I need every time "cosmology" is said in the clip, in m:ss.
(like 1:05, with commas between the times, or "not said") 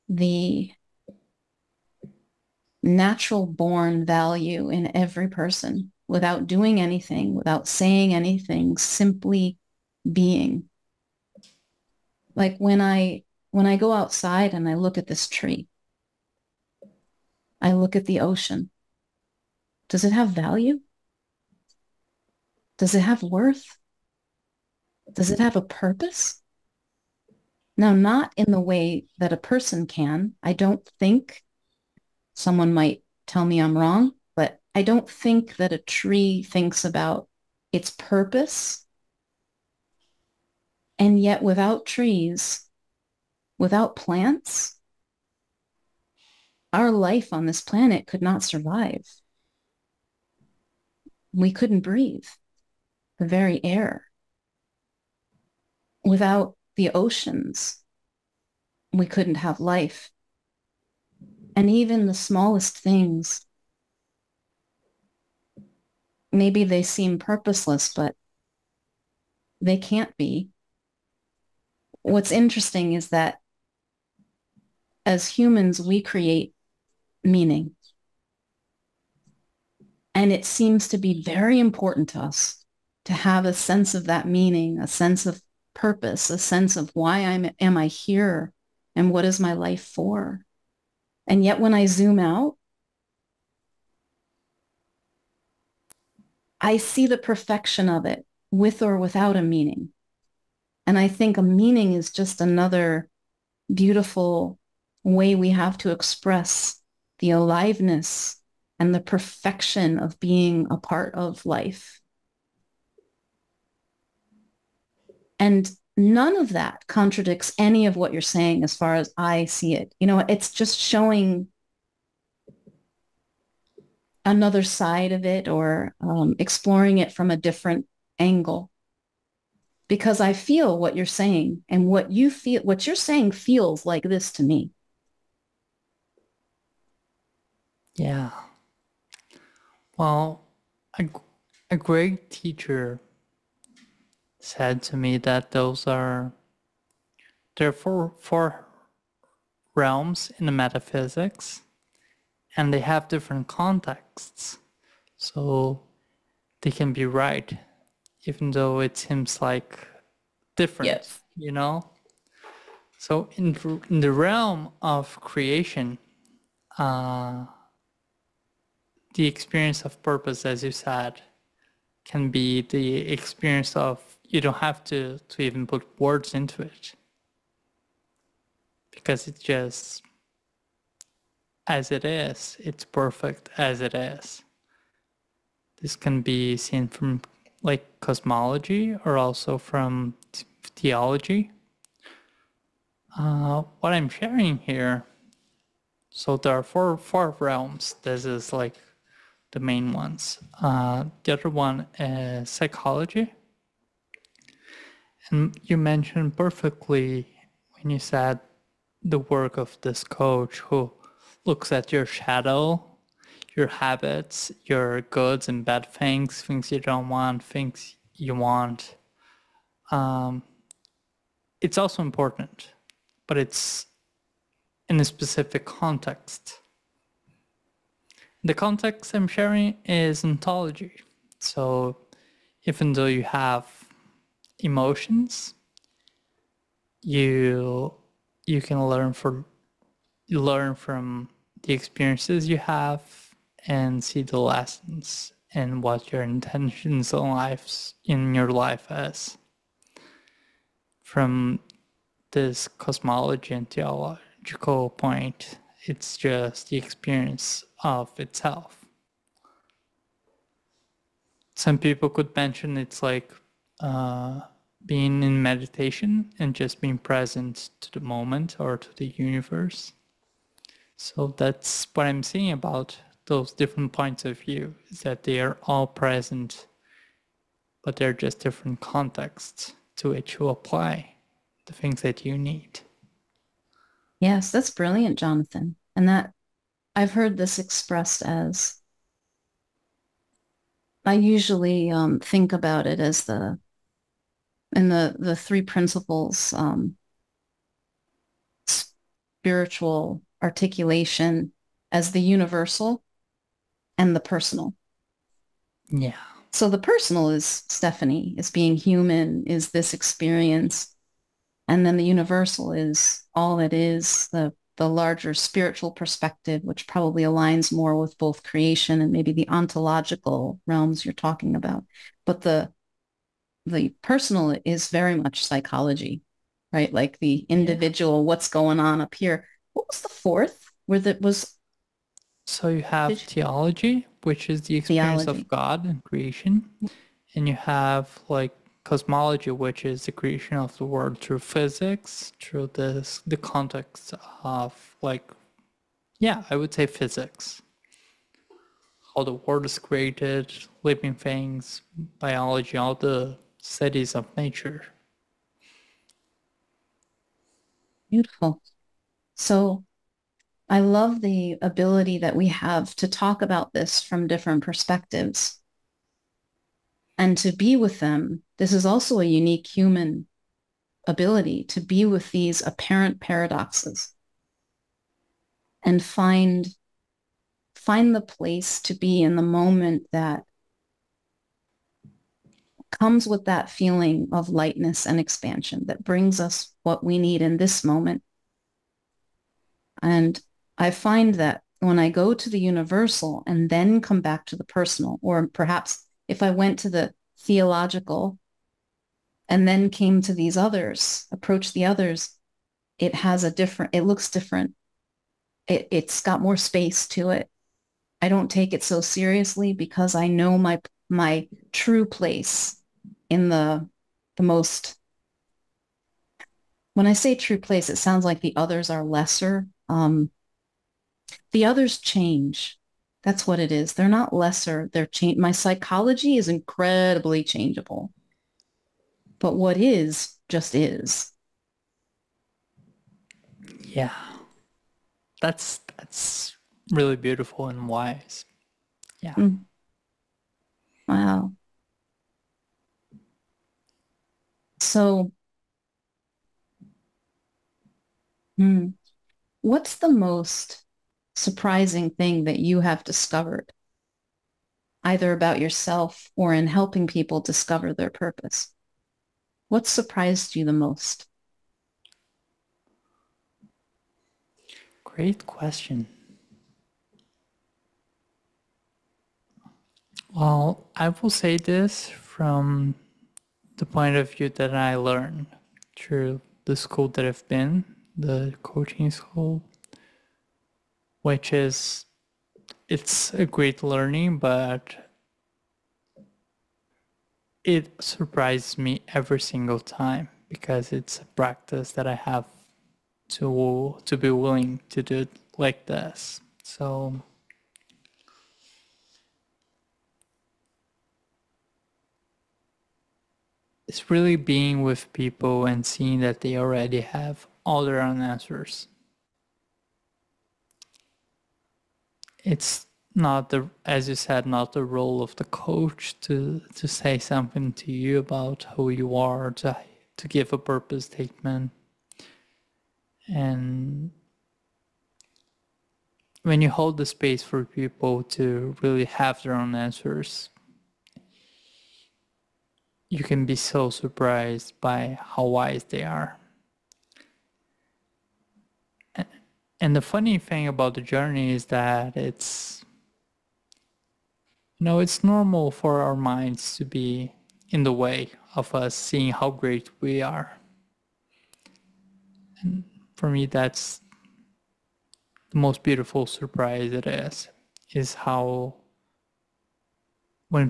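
3:07, 4:12, 5:38.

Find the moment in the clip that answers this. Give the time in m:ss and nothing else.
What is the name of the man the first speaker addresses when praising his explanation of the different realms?
4:45.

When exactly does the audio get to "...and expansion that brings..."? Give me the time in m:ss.
6:25.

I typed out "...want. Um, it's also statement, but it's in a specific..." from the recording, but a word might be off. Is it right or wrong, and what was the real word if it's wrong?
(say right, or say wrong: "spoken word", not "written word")
wrong: "important", not "statement".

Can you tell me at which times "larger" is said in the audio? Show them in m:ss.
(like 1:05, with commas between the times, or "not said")
5:14.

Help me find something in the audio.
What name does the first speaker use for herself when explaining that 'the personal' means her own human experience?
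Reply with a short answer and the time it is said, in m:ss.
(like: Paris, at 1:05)
Stephanie, at 5:07.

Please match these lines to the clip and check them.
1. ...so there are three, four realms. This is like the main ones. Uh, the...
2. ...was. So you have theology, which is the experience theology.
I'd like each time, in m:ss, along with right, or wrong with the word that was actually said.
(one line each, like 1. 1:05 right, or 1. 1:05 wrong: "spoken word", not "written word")
1. 3:16 wrong: "four", not "three"
2. 5:31 right.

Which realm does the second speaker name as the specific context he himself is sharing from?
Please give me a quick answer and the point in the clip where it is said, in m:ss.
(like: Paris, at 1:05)
ontology, at 3:50.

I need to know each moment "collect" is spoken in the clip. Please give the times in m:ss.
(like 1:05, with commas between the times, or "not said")
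not said.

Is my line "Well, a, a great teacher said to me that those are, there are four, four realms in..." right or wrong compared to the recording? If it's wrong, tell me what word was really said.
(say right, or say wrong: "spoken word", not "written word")
right.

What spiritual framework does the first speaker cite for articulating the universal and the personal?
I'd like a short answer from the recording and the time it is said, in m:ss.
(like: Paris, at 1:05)
the three principles, at 4:55.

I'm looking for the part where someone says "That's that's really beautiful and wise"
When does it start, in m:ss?
7:15.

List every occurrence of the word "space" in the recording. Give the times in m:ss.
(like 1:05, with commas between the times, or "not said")
6:46, 8:47.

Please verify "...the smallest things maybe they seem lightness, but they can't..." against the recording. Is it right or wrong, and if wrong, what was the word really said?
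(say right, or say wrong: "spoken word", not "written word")
wrong: "purposeless", not "lightness".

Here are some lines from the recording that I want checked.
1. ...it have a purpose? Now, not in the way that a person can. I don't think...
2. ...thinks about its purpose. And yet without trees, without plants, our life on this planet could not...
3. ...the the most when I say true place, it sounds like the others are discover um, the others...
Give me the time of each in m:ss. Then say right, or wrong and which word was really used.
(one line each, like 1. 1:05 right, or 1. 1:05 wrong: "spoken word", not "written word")
1. 0:25 right
2. 0:36 right
3. 6:53 wrong: "lesser", not "discover".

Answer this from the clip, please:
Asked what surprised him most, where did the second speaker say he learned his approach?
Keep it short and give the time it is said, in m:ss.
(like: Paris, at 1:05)
coaching school, at 7:58.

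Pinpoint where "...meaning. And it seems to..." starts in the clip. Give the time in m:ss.
1:17.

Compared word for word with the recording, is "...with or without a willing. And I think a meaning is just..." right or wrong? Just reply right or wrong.
wrong.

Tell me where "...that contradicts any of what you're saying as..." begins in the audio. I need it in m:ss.
1:56.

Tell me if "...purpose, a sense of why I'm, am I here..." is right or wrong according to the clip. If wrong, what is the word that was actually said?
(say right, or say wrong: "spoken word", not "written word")
right.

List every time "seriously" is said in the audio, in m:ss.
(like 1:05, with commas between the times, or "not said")
6:48.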